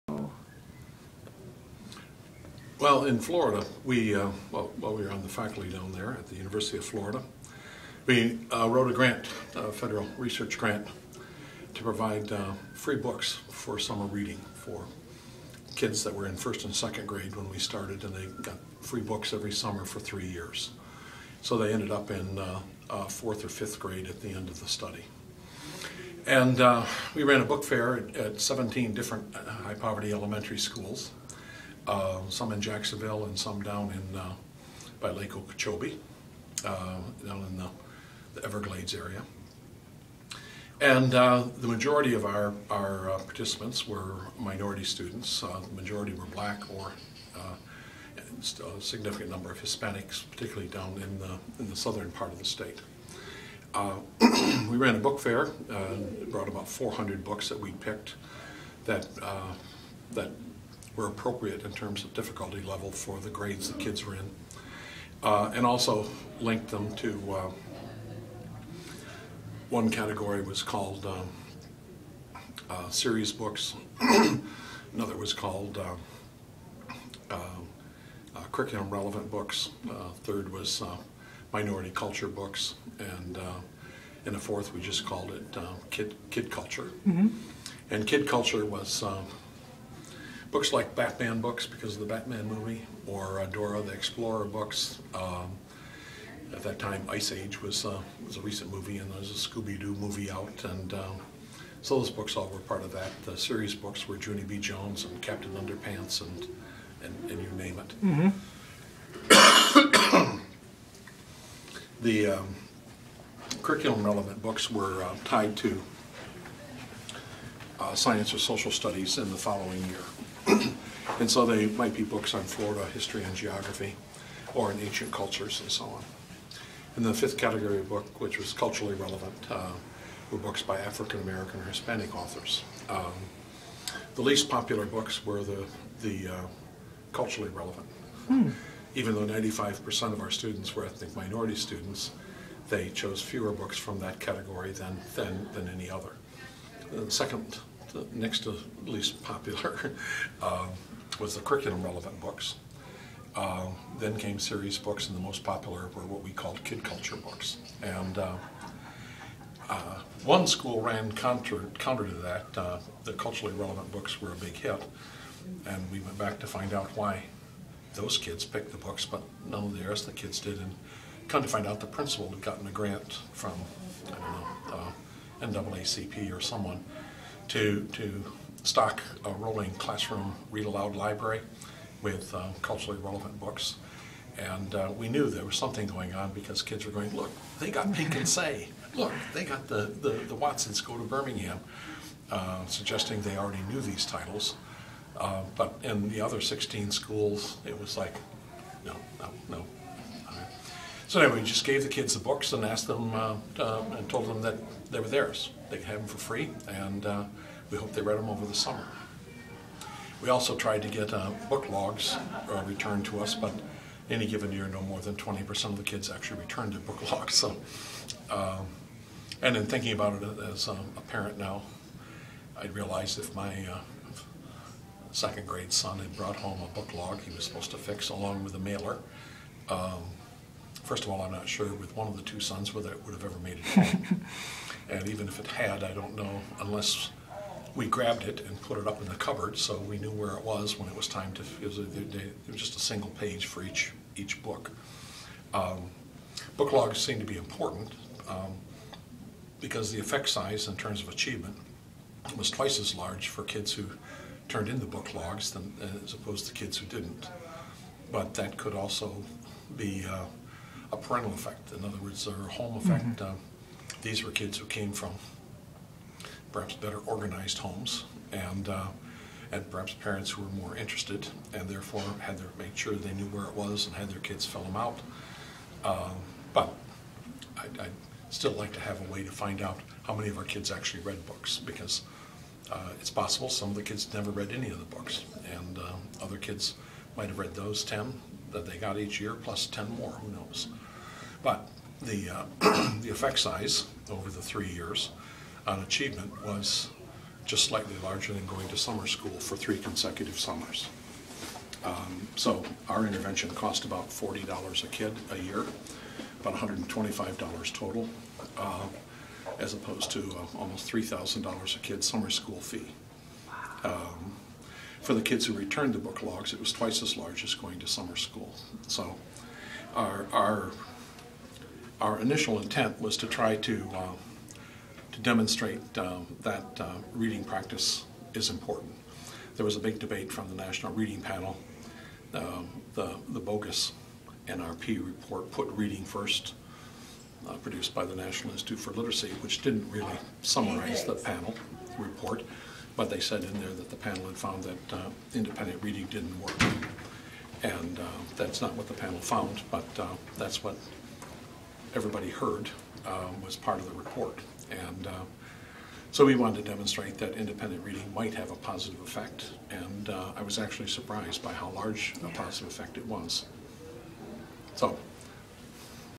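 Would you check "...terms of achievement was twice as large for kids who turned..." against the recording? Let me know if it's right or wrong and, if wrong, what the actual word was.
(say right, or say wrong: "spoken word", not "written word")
right.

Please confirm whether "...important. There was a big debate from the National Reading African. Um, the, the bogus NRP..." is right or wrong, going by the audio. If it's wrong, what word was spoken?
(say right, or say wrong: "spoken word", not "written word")
wrong: "Panel", not "African".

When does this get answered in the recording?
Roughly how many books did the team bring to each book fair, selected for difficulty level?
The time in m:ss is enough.
0:56.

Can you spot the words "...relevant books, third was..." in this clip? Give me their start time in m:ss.
1:18.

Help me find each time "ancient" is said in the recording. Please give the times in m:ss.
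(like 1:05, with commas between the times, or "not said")
2:04.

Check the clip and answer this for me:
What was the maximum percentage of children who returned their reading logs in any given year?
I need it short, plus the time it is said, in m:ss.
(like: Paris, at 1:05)
20%, at 3:35.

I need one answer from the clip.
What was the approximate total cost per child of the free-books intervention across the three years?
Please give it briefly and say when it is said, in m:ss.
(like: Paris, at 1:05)
$125, at 5:06.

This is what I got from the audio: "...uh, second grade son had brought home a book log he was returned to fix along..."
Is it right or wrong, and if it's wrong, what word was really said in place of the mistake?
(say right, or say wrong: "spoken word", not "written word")
wrong: "supposed", not "returned".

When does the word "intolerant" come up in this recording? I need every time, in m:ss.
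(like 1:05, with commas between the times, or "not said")
not said.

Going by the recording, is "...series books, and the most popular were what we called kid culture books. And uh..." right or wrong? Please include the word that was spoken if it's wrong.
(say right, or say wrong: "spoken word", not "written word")
right.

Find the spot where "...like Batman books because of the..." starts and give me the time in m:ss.
1:30.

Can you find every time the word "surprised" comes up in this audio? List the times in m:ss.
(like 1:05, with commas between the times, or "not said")
6:00.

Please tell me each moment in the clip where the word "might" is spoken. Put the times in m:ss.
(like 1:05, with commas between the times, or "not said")
2:01, 4:47, 5:58.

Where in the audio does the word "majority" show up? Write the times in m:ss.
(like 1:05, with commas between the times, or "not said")
0:41, 0:45.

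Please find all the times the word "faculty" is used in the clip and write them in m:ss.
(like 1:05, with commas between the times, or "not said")
0:05.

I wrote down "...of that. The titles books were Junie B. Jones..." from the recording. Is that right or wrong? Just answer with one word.
wrong.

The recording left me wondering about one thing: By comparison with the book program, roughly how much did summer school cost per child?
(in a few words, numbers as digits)
$3,000.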